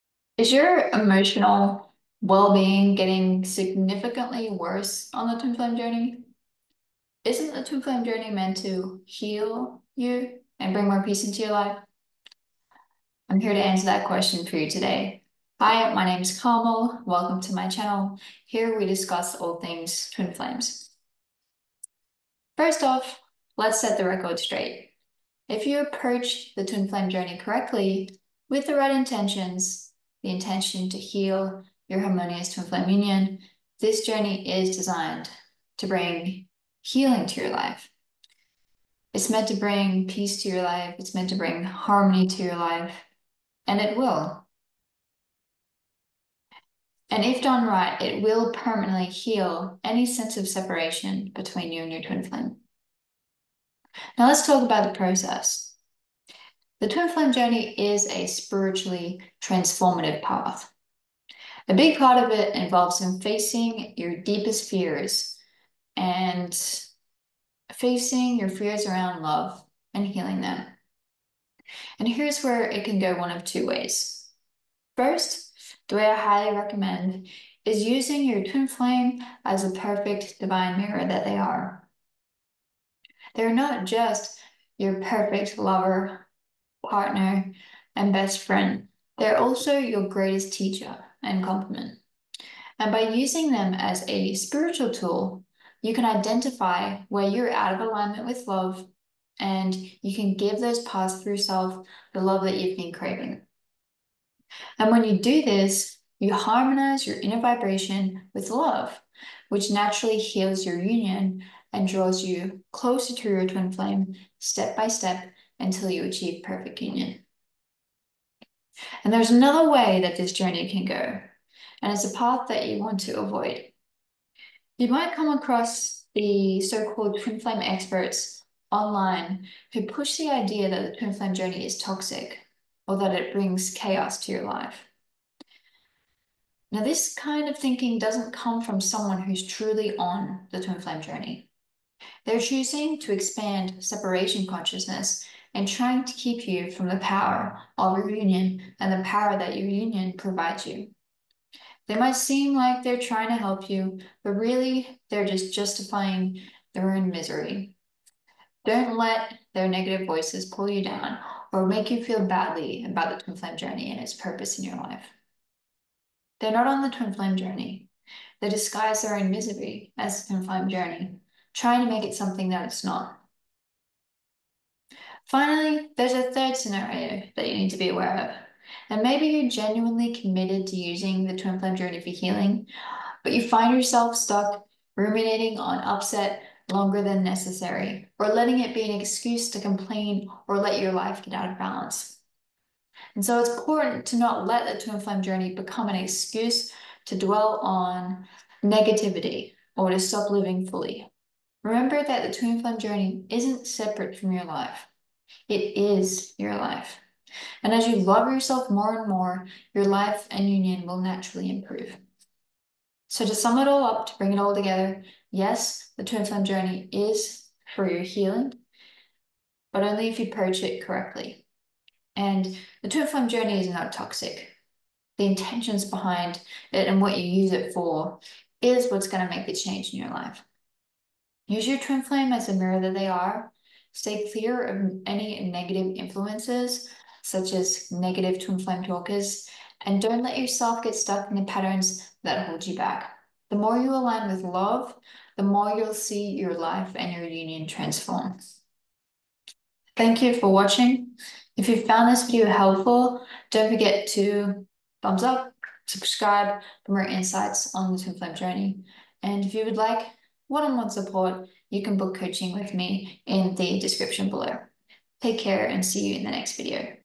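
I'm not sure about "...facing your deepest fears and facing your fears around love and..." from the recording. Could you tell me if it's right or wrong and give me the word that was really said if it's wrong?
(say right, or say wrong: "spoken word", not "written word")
right.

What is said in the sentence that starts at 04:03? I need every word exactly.
The more you align with love, the more you'll see your life and your union transform.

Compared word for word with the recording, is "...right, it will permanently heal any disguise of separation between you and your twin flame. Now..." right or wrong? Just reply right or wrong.
wrong.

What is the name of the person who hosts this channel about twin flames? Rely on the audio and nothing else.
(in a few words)
Carmel.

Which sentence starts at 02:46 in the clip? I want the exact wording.
They're not on the twin flame journey.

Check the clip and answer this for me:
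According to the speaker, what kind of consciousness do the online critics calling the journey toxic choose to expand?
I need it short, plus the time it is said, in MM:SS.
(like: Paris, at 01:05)
separation consciousness, at 02:23.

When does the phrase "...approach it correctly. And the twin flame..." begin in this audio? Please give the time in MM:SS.
03:40.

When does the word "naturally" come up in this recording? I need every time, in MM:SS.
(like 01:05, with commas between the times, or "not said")
01:49, 03:31.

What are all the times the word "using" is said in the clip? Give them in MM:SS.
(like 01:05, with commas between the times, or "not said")
01:17, 01:33, 03:00.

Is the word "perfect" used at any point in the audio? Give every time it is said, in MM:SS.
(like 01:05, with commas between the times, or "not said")
01:19, 01:24, 01:56.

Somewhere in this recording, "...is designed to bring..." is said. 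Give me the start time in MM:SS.
00:34.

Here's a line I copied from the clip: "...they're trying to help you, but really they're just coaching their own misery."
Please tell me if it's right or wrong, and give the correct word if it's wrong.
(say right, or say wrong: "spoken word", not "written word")
wrong: "justifying", not "coaching".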